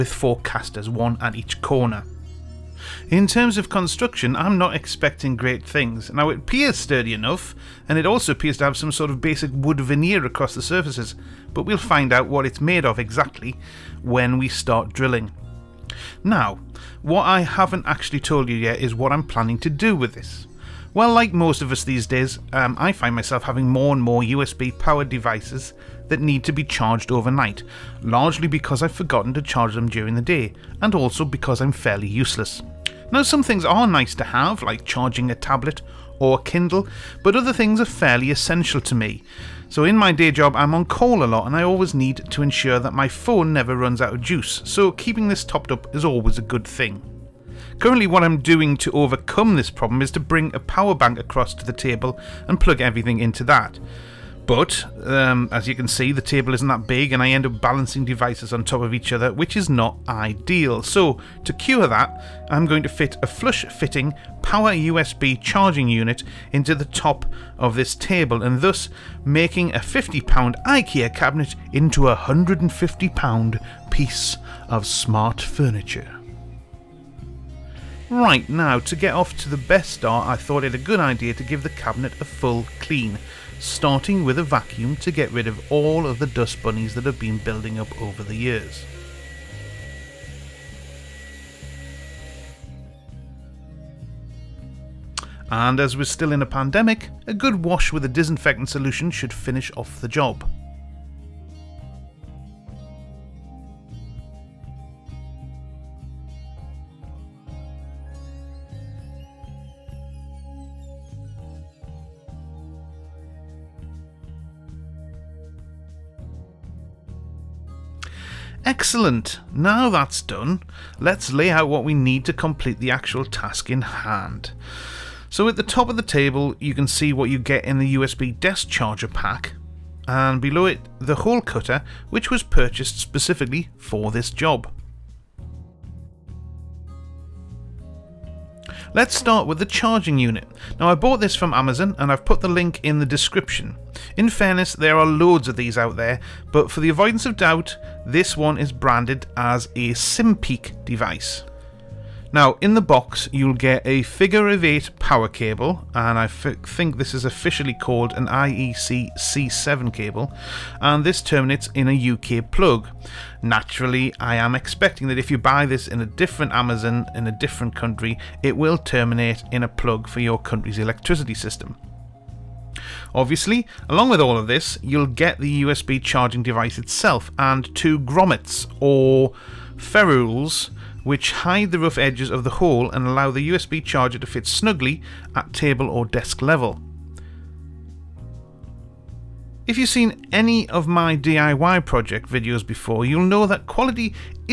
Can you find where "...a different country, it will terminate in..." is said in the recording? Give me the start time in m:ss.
2:47.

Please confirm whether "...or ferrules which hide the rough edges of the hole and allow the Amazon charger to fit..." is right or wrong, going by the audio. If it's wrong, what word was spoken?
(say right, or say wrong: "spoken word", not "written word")
wrong: "USB", not "Amazon".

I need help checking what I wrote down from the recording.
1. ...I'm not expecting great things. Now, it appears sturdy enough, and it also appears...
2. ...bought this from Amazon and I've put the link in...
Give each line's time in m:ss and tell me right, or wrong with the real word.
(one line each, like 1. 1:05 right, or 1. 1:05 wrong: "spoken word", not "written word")
1. 0:04 right
2. 2:20 right.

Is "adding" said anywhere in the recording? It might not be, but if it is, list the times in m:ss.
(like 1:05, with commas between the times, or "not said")
not said.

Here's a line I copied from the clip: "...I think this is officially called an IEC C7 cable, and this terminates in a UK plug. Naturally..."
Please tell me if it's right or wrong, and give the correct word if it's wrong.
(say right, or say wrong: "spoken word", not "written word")
right.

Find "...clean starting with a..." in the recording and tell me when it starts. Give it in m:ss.
1:22.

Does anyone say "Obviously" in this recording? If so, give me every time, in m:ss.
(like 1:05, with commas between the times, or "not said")
2:53.